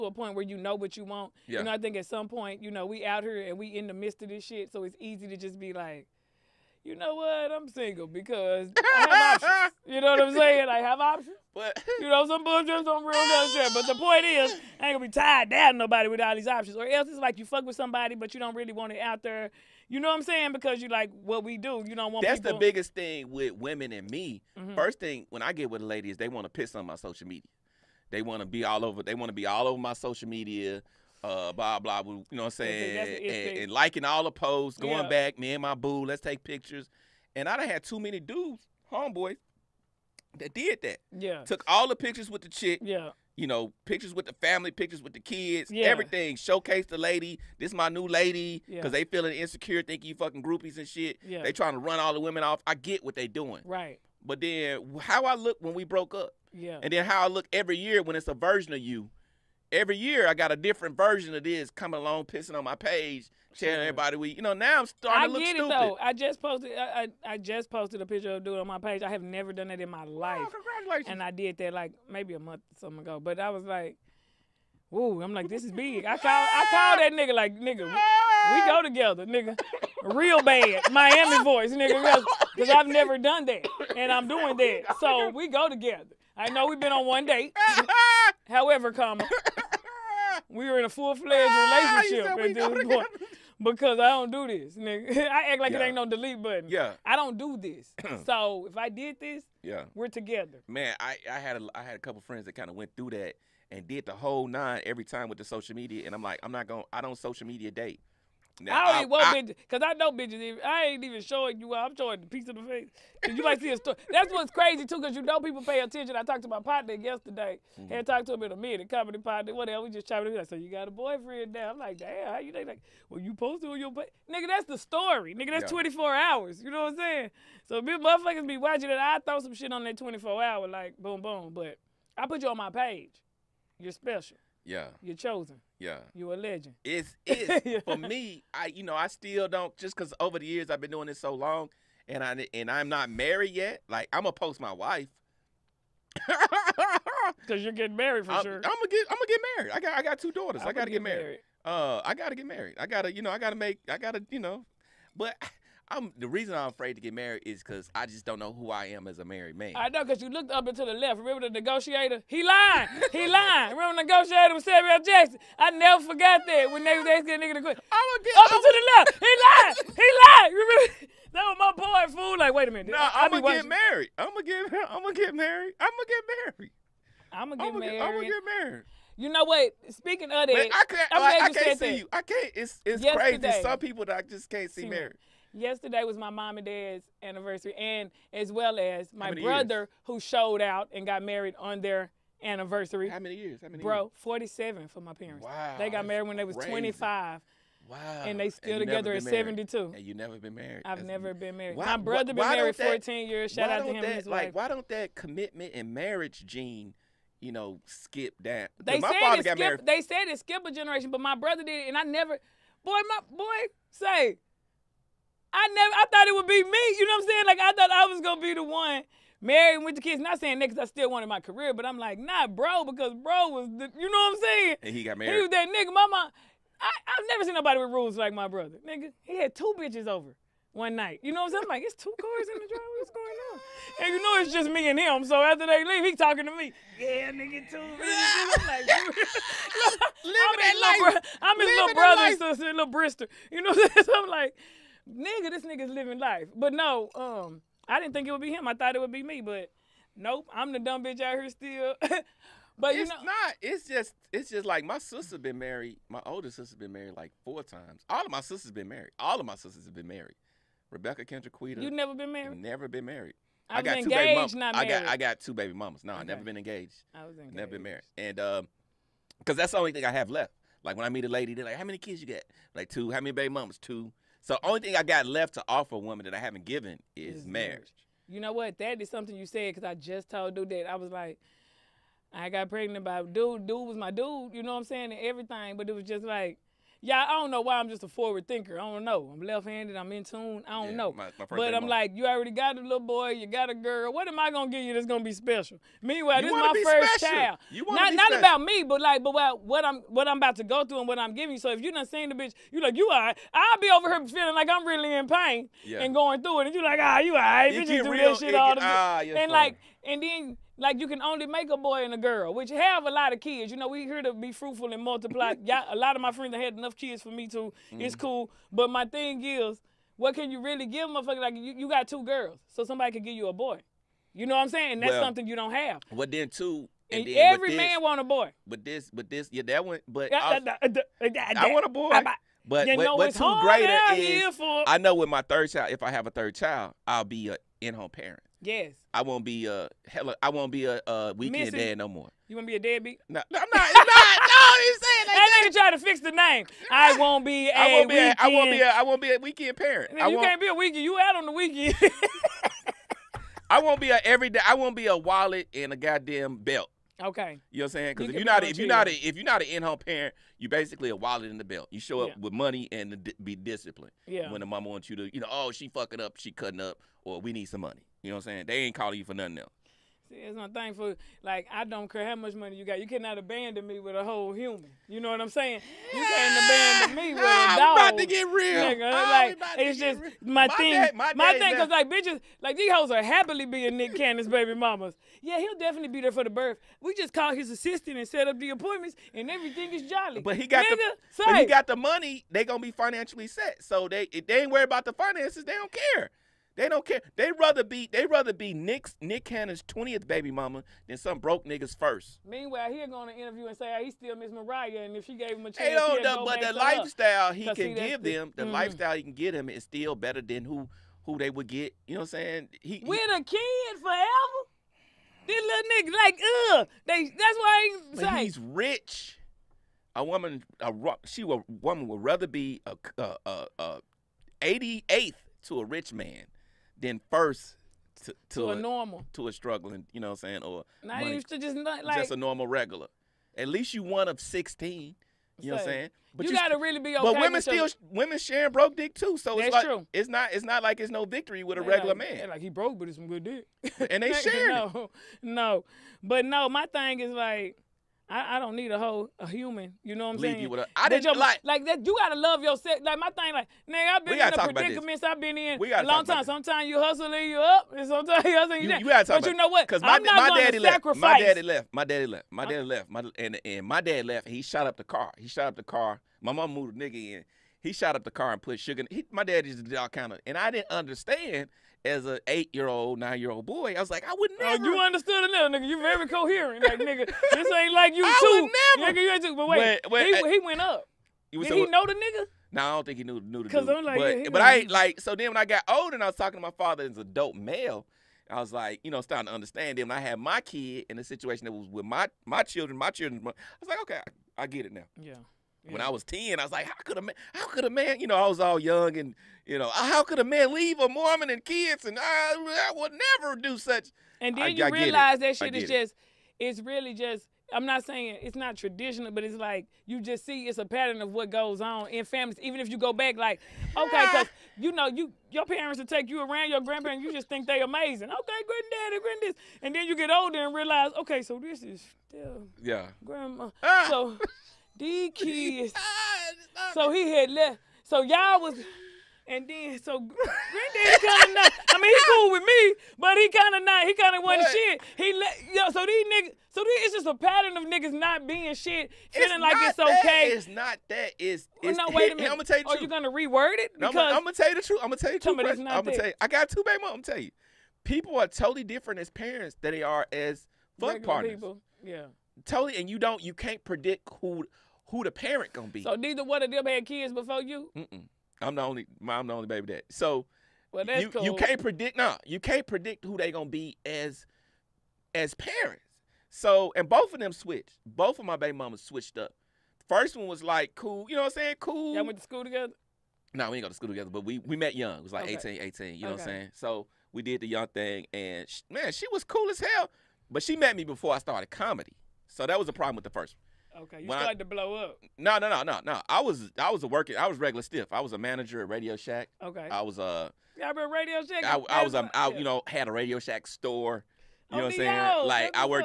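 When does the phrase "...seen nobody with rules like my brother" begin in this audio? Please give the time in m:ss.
3:47.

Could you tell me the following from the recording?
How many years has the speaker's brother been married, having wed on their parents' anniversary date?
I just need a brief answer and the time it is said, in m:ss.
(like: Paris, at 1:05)
14, at 3:22.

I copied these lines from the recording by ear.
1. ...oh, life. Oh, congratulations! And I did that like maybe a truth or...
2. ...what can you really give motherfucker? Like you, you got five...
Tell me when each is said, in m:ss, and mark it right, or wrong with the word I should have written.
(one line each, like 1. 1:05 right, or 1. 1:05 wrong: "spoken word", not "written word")
1. 1:10 wrong: "month", not "truth"
2. 5:20 wrong: "two", not "five".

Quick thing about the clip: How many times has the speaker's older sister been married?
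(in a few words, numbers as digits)
4.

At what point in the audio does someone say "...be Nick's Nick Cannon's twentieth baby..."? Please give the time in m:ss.
6:38.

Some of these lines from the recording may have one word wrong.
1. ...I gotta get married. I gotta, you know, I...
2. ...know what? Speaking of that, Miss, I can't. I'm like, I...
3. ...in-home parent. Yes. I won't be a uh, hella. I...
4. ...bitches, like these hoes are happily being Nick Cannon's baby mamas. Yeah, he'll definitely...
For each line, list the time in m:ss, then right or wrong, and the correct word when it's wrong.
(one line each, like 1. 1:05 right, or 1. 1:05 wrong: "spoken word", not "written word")
1. 2:32 right
2. 2:59 wrong: "Man", not "Miss"
3. 5:37 right
4. 6:22 right.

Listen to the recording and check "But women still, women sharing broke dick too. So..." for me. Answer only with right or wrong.
right.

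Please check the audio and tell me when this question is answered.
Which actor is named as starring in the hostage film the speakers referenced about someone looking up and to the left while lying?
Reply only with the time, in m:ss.
2:43.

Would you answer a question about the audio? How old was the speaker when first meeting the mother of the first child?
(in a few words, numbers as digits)
18.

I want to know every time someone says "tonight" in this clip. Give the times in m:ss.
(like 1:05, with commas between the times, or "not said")
not said.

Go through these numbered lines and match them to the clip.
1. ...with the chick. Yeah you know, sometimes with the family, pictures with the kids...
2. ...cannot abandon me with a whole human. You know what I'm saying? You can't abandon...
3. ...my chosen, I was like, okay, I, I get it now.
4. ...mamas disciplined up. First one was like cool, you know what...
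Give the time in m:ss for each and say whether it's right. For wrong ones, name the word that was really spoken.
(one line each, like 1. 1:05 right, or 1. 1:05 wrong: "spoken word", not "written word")
1. 0:42 wrong: "pictures", not "sometimes"
2. 6:13 right
3. 8:12 wrong: "children", not "chosen"
4. 9:28 wrong: "switched", not "disciplined".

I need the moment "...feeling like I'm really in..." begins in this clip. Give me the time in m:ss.
5:04.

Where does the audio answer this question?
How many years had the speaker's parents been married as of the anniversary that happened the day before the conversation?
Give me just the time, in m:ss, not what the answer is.
3:14.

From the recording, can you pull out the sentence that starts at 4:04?
So I'm like, nigga, this nigga's living life.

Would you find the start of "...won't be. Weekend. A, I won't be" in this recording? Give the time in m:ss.
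5:47.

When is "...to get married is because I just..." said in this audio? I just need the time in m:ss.
2:36.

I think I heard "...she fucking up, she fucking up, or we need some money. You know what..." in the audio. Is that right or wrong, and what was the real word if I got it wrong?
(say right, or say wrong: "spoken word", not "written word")
wrong: "cutting", not "fucking".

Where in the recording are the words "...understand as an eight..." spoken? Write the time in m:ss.
7:50.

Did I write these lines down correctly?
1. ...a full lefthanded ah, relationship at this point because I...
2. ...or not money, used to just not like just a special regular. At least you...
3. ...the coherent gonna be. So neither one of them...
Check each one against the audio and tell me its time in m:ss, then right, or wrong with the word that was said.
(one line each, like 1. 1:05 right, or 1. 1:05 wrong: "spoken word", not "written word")
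1. 1:30 wrong: "fledged", not "lefthanded"
2. 7:10 wrong: "normal", not "special"
3. 9:15 wrong: "parent", not "coherent".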